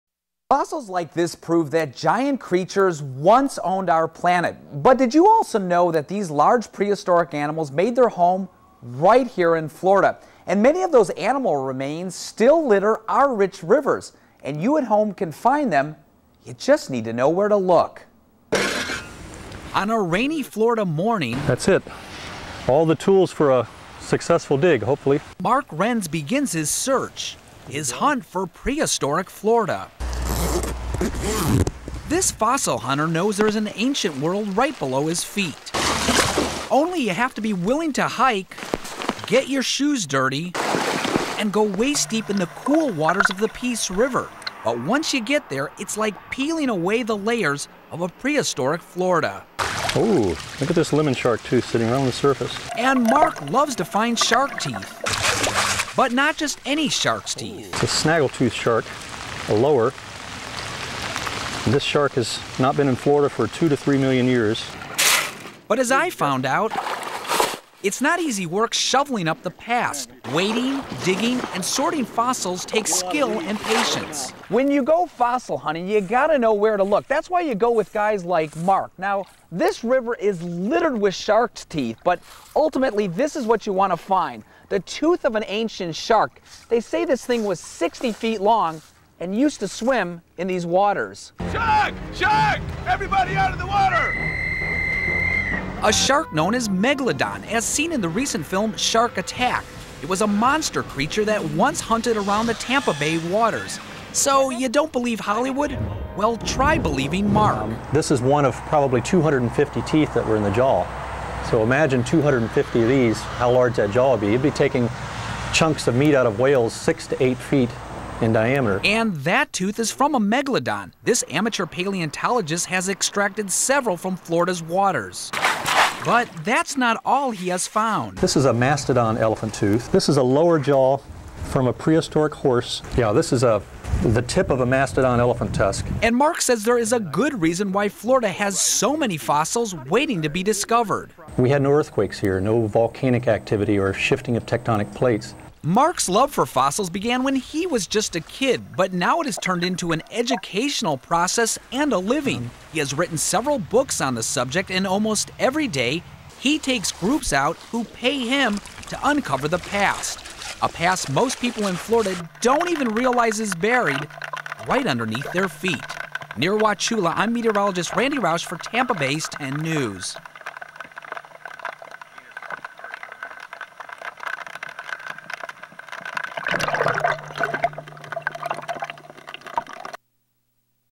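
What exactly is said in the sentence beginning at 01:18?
Now, this river is littered with shark's teeth, but ultimately, this is what you wanna find the tooth of an ancient shark.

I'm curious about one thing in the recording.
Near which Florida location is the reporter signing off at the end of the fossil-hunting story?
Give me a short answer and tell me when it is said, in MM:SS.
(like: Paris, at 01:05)
Wauchula, at 02:46.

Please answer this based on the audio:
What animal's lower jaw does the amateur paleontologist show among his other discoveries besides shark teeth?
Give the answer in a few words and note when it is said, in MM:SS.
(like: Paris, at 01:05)
prehistoric horse, at 02:11.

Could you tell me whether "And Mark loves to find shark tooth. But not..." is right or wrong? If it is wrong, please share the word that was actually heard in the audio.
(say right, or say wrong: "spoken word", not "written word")
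wrong: "teeth", not "tooth".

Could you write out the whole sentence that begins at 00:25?
Mark Renz begins his search, his hunt for prehistoric Florida.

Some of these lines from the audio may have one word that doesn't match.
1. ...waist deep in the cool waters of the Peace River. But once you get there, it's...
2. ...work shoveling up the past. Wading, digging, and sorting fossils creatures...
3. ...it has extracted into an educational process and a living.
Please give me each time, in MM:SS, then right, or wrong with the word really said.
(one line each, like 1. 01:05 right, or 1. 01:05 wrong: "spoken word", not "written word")
1. 00:41 right
2. 01:08 wrong: "takes", not "creatures"
3. 02:29 wrong: "turned", not "extracted".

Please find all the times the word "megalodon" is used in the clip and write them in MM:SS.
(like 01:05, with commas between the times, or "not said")
01:36, 02:00.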